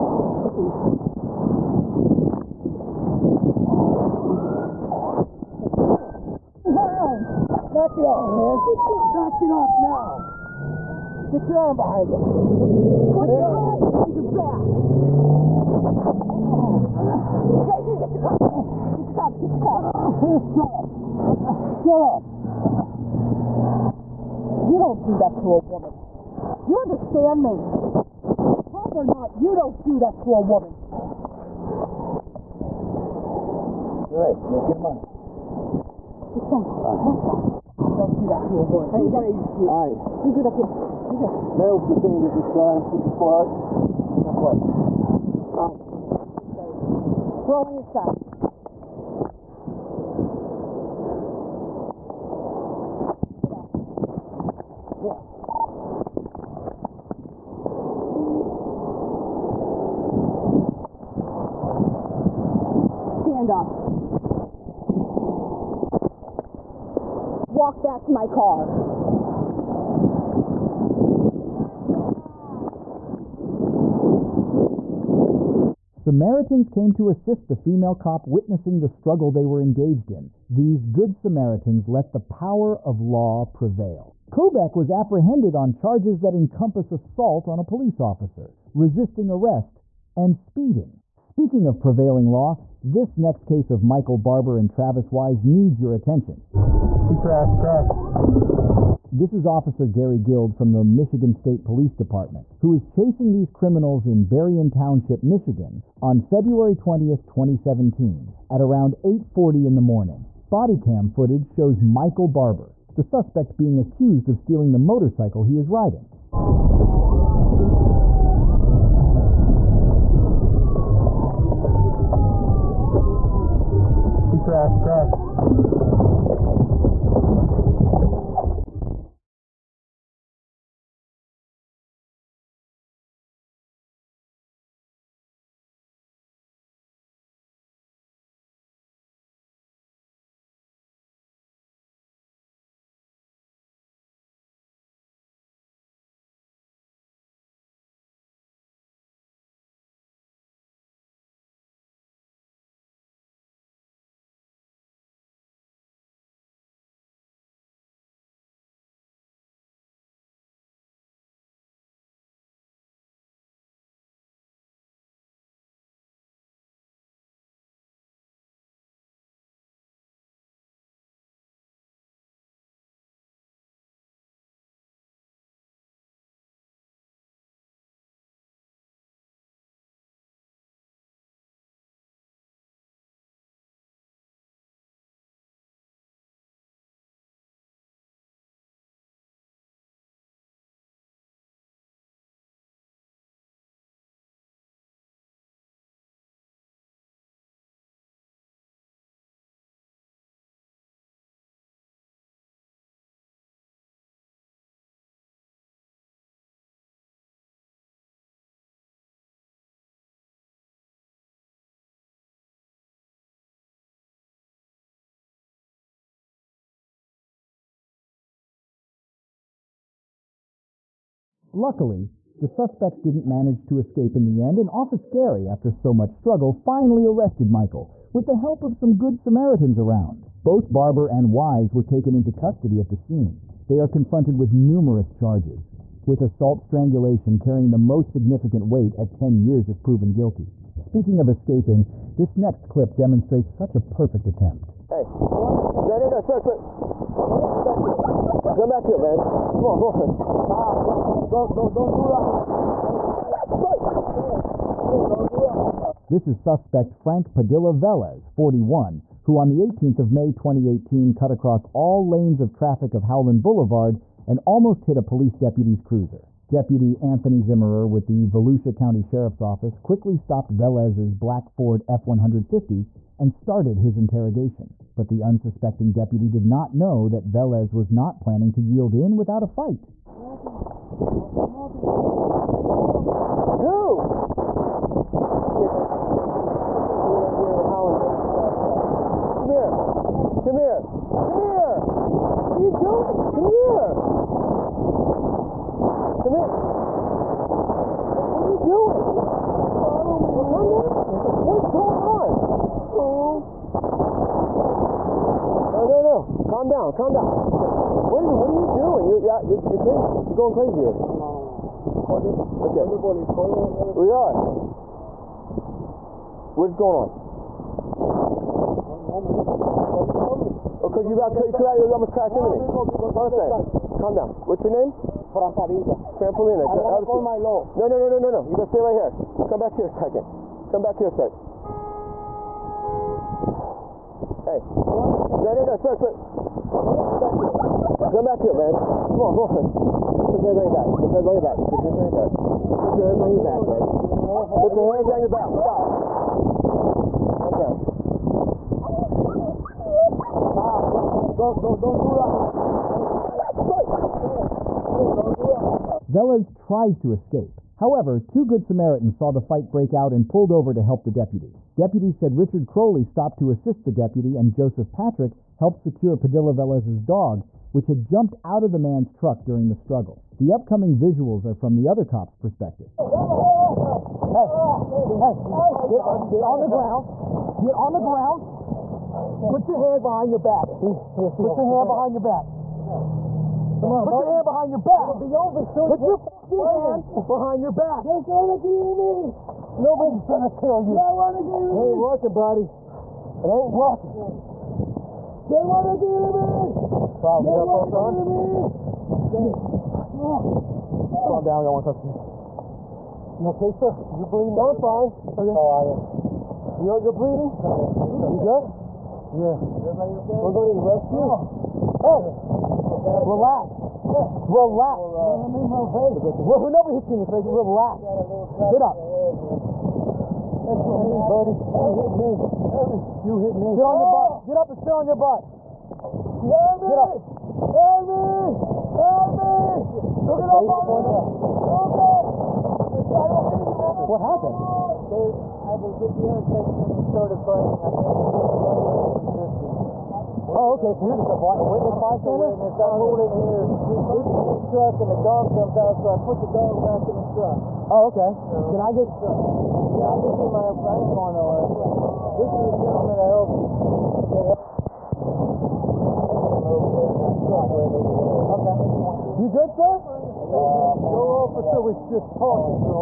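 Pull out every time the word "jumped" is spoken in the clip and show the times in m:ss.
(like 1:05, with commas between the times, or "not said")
6:08, 7:25.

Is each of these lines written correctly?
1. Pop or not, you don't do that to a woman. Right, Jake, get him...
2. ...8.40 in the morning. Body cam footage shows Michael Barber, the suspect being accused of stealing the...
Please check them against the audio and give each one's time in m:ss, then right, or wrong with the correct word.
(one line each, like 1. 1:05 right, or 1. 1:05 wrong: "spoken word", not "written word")
1. 0:28 right
2. 1:49 right.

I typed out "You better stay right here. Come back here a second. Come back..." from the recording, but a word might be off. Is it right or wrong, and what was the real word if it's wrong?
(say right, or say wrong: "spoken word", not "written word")
right.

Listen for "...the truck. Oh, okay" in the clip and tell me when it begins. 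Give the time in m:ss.
7:27.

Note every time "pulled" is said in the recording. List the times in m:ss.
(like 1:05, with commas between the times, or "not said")
6:00, 7:23.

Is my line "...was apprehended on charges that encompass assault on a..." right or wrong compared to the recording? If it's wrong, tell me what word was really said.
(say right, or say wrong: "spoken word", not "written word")
right.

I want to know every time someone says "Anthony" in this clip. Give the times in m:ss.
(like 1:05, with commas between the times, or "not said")
4:26.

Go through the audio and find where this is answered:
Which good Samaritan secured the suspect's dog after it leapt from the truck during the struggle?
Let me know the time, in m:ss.
6:04.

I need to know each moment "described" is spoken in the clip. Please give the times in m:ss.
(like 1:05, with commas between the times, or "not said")
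not said.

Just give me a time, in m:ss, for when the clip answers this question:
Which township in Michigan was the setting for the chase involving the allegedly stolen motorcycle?
1:44.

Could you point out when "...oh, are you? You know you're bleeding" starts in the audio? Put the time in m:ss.
6:45.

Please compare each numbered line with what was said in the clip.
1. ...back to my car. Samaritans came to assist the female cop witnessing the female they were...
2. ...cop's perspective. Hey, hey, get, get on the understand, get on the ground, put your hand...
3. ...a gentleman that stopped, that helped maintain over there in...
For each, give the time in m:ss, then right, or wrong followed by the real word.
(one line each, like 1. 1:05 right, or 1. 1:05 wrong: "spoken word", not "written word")
1. 1:07 wrong: "struggle", not "female"
2. 6:12 wrong: "ground", not "understand"
3. 7:32 wrong: "helped", not "stopped".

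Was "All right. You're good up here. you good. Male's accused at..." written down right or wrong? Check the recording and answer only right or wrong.
wrong.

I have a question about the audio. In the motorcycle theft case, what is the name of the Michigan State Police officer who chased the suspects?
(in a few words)
Gary Guild.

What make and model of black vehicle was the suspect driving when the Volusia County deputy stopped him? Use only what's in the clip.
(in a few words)
Ford F-150.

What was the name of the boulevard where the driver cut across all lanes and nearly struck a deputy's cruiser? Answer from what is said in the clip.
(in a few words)
Howland Boulevard.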